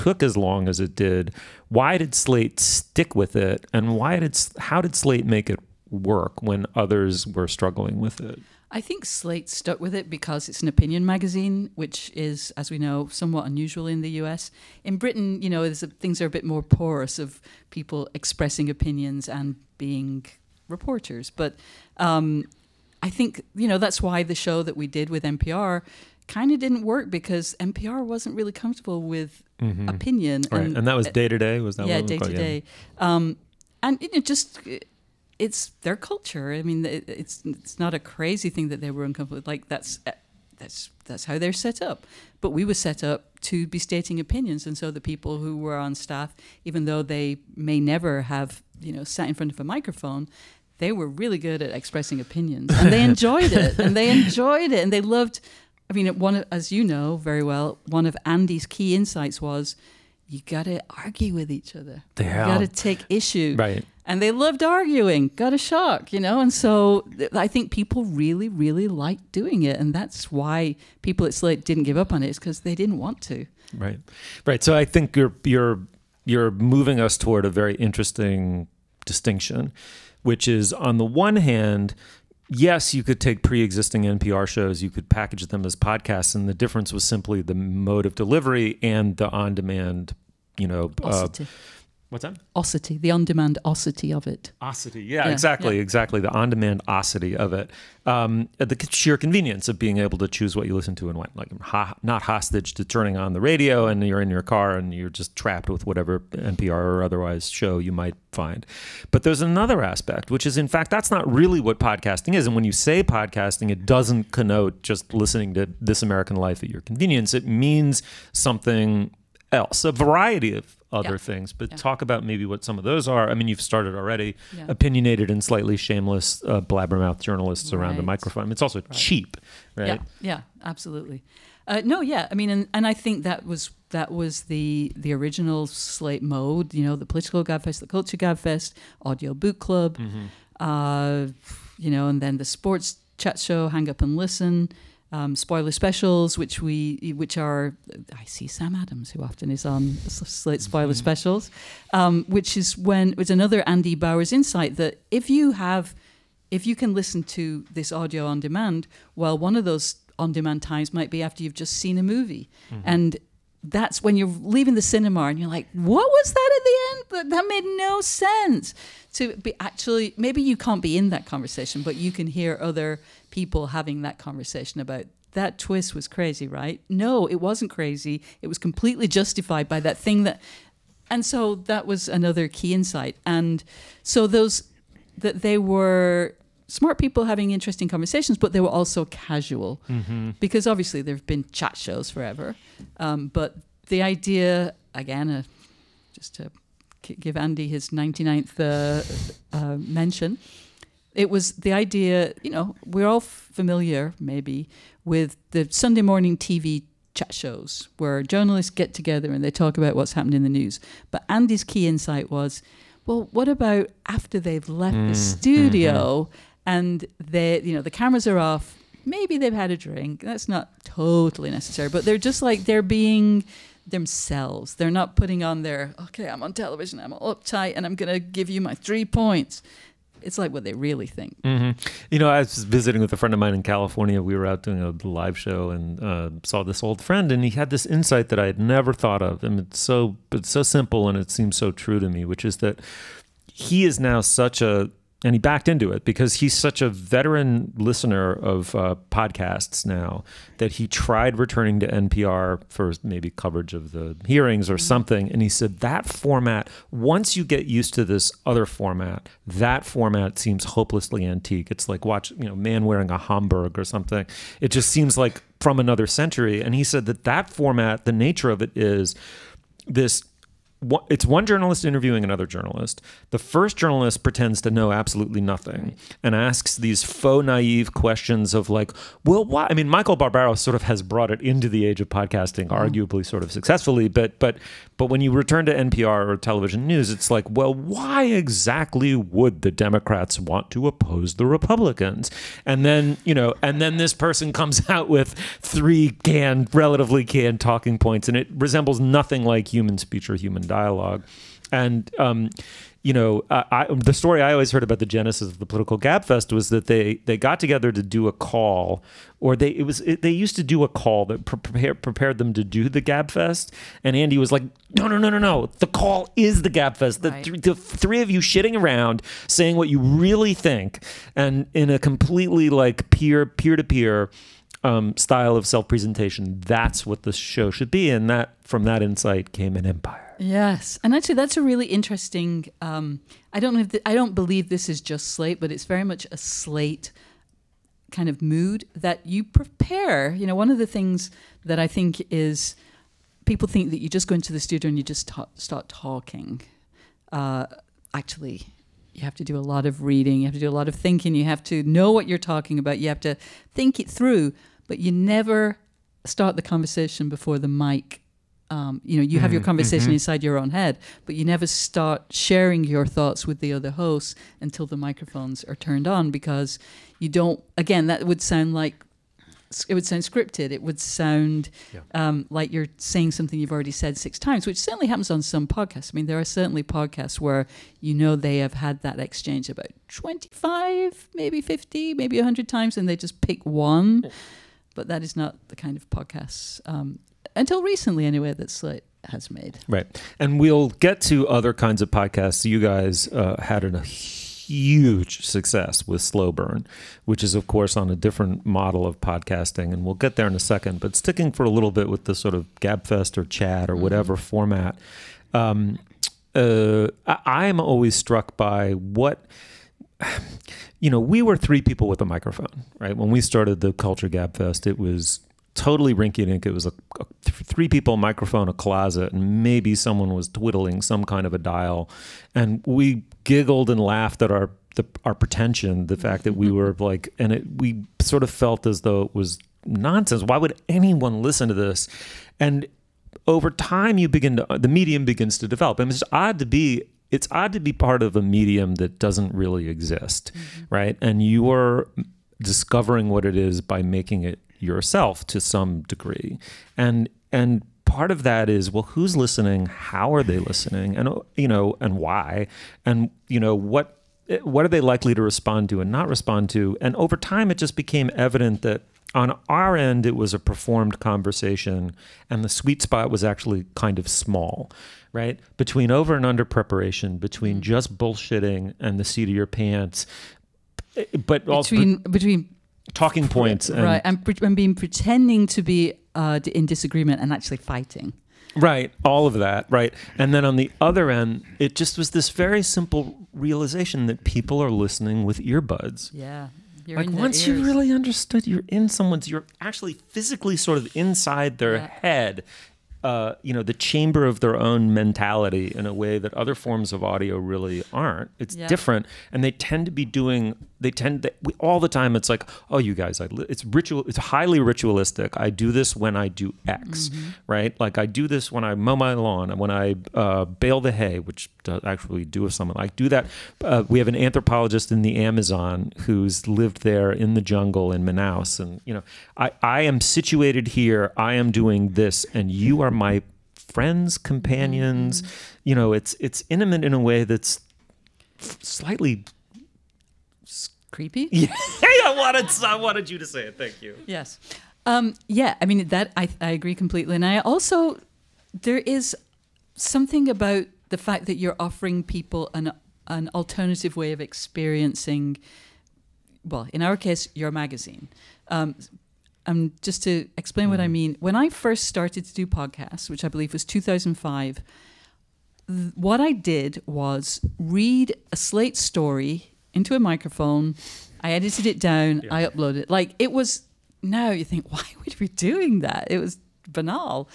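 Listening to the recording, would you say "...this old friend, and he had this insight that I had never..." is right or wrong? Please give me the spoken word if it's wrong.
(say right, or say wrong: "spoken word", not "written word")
right.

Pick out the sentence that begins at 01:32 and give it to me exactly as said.
Ossity, the on-demand ossity of it.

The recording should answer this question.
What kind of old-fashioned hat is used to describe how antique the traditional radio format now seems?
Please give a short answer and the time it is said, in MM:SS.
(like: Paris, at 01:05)
Homburg, at 04:23.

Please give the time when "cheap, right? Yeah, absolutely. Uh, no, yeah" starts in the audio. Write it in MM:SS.
02:08.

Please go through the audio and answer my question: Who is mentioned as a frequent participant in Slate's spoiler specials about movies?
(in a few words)
Sam Adams.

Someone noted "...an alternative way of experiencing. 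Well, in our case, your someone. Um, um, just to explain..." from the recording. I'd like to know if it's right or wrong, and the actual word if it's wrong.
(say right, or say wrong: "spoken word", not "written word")
wrong: "magazine", not "someone".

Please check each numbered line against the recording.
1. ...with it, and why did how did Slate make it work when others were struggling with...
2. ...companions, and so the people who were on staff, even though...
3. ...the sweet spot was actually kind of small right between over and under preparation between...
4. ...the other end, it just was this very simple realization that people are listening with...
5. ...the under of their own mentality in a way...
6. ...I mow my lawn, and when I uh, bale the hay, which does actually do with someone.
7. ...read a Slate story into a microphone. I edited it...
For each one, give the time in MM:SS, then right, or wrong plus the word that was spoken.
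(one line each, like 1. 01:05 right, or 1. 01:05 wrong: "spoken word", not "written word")
1. 00:03 right
2. 00:44 wrong: "opinions", not "companions"
3. 07:42 right
4. 08:00 right
5. 08:13 wrong: "chamber", not "under"
6. 08:28 right
7. 09:17 right.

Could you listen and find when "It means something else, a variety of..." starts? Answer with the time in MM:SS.
01:57.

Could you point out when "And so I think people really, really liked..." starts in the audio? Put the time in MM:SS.
01:06.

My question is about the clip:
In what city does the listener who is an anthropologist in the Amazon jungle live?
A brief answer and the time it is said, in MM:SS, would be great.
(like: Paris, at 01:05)
Manaus, at 08:38.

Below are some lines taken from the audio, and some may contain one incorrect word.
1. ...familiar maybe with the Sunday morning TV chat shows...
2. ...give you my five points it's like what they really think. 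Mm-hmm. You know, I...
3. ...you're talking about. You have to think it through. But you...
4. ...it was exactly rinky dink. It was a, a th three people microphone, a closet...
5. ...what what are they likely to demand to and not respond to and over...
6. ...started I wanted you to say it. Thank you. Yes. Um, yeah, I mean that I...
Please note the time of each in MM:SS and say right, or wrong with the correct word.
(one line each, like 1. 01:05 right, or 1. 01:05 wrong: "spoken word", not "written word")
1. 03:23 right
2. 03:48 wrong: "three", not "five"
3. 05:52 right
4. 06:54 wrong: "totally", not "exactly"
5. 07:33 wrong: "respond", not "demand"
6. 08:52 wrong: "wanted", not "started".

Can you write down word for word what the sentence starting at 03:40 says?
That's not totally necessary, but they're just like they're being themselves.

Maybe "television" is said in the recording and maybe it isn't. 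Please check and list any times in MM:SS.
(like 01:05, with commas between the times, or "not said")
03:46, 04:46.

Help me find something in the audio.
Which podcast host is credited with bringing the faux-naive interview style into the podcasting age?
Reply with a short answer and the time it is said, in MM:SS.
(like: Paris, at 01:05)
Michael Barbaro, at 04:39.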